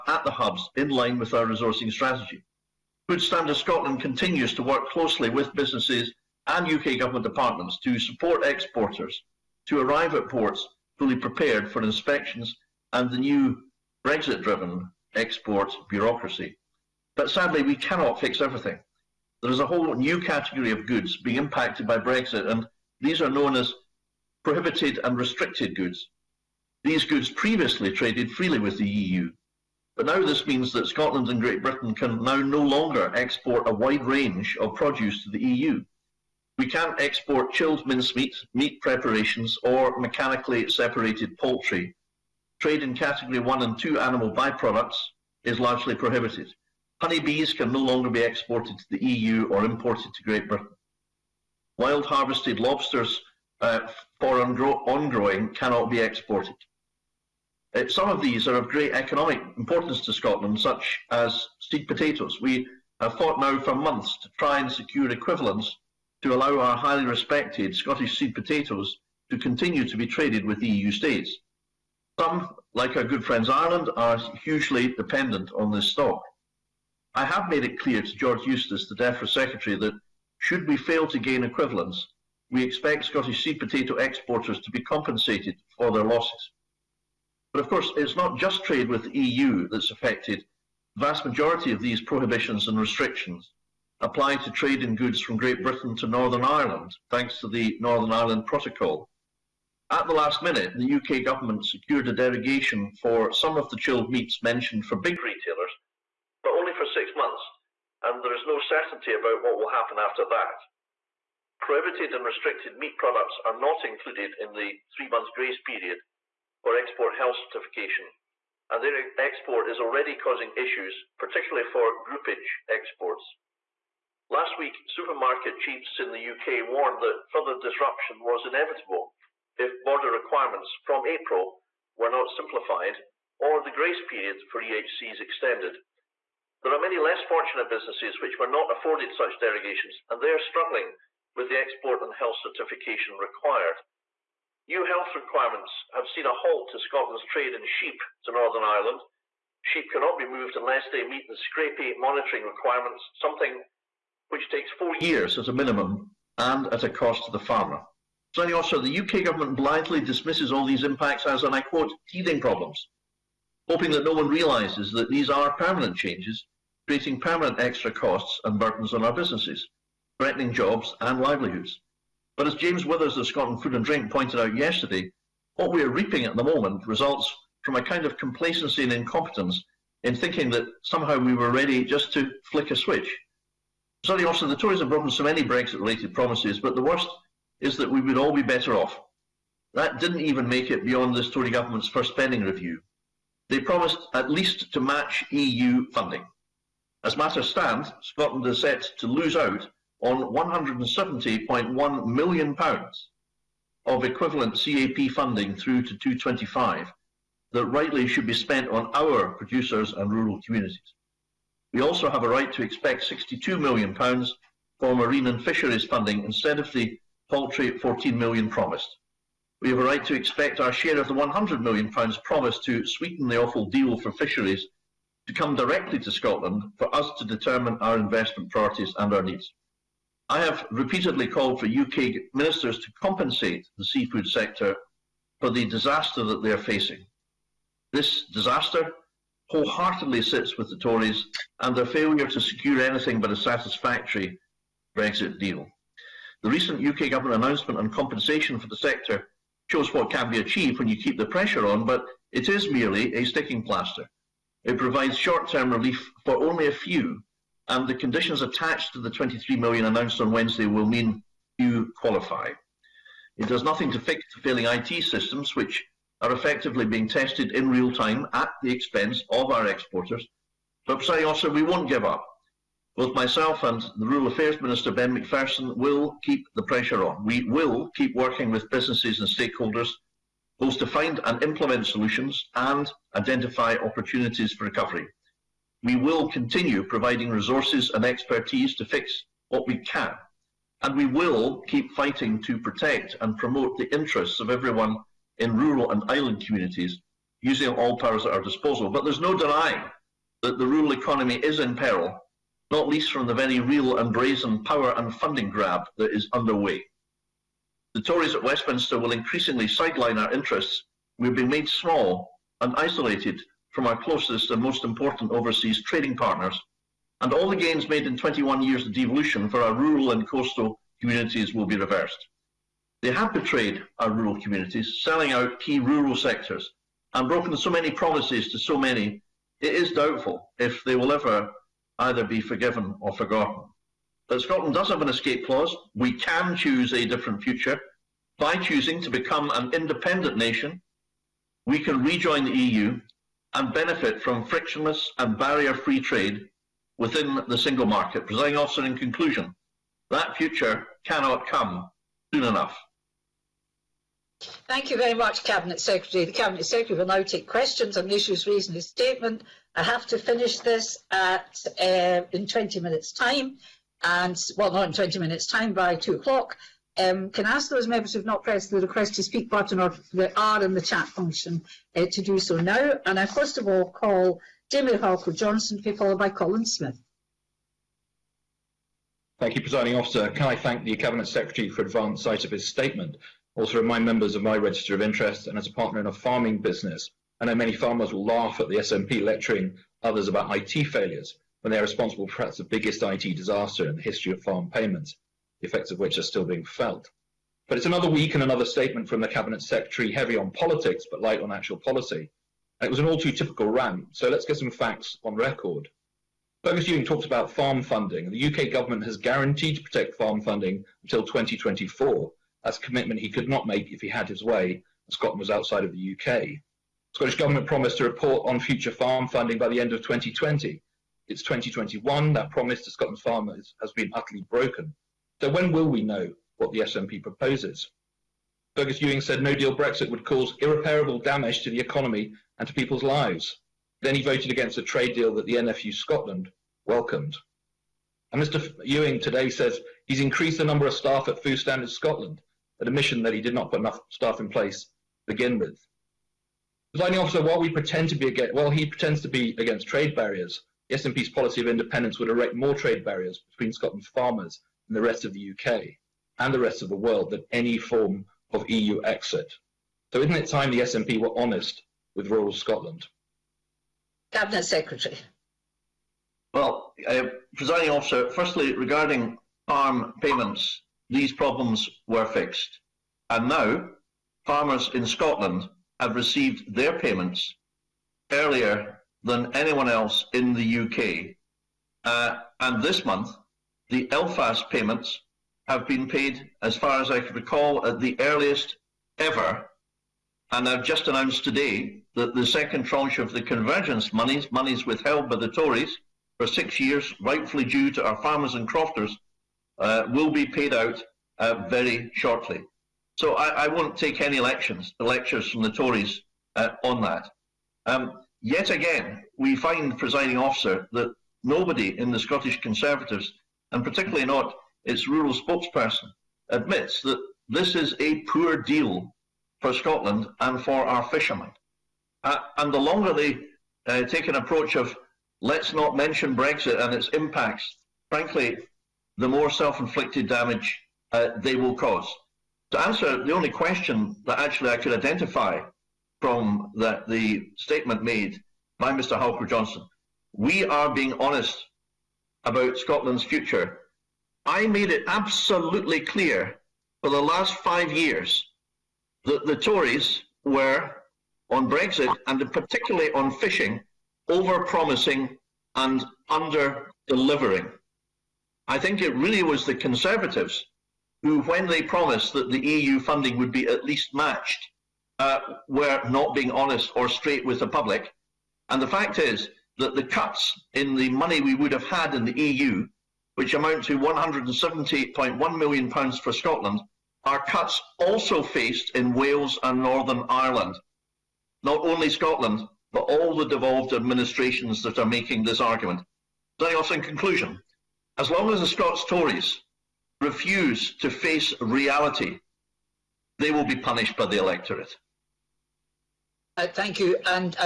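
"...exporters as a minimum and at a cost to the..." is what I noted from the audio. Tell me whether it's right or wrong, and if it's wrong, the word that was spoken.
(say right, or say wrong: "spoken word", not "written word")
wrong: "years", not "exporters".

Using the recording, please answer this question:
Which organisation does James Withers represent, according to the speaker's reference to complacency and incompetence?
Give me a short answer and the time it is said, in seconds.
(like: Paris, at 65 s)
Scotland Food and Drink, at 173 s.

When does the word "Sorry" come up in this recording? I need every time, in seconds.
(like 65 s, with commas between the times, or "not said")
184 s.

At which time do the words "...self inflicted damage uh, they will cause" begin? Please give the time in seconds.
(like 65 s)
529 s.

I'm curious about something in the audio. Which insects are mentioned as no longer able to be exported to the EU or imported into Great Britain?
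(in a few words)
Honeybees.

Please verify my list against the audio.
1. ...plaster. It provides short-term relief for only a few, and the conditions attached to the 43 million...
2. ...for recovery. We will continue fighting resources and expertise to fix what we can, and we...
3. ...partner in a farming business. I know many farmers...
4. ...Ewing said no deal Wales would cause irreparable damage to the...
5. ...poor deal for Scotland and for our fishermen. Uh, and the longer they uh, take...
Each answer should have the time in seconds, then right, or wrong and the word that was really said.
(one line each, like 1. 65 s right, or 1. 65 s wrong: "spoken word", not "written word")
1. 253 s wrong: "23", not "43"
2. 284 s wrong: "providing", not "fighting"
3. 385 s right
4. 429 s wrong: "Brexit", not "Wales"
5. 518 s right.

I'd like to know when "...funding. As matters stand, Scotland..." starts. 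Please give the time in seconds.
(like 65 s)
195 s.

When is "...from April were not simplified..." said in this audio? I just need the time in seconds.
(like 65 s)
130 s.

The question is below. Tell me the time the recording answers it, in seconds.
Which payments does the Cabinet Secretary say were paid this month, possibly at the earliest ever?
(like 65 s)
484 s.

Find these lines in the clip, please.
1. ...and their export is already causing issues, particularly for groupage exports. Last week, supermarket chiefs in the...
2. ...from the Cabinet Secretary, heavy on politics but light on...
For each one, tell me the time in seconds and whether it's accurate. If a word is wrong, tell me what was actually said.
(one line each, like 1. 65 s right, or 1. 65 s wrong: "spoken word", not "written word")
1. 118 s right
2. 399 s right.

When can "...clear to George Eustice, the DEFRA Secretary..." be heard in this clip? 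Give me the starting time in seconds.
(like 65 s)
77 s.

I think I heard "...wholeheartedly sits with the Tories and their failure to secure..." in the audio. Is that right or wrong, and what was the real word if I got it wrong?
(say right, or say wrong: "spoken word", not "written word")
right.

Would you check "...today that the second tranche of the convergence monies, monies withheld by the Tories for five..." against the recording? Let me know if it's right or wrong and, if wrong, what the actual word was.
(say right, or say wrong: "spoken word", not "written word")
wrong: "six", not "five".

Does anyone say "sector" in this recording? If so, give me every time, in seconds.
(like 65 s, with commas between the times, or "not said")
234 s, 248 s, 326 s.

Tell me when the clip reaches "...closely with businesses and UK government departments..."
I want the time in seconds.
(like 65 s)
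4 s.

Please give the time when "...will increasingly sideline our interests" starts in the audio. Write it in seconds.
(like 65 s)
308 s.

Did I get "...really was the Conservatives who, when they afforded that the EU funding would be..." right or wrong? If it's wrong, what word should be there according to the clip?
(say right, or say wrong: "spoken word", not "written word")
wrong: "promised", not "afforded".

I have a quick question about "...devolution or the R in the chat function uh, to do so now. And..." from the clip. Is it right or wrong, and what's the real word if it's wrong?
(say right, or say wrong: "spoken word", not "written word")
wrong: "button", not "devolution".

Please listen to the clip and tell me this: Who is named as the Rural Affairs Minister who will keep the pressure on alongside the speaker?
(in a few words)
Ben Macpherson.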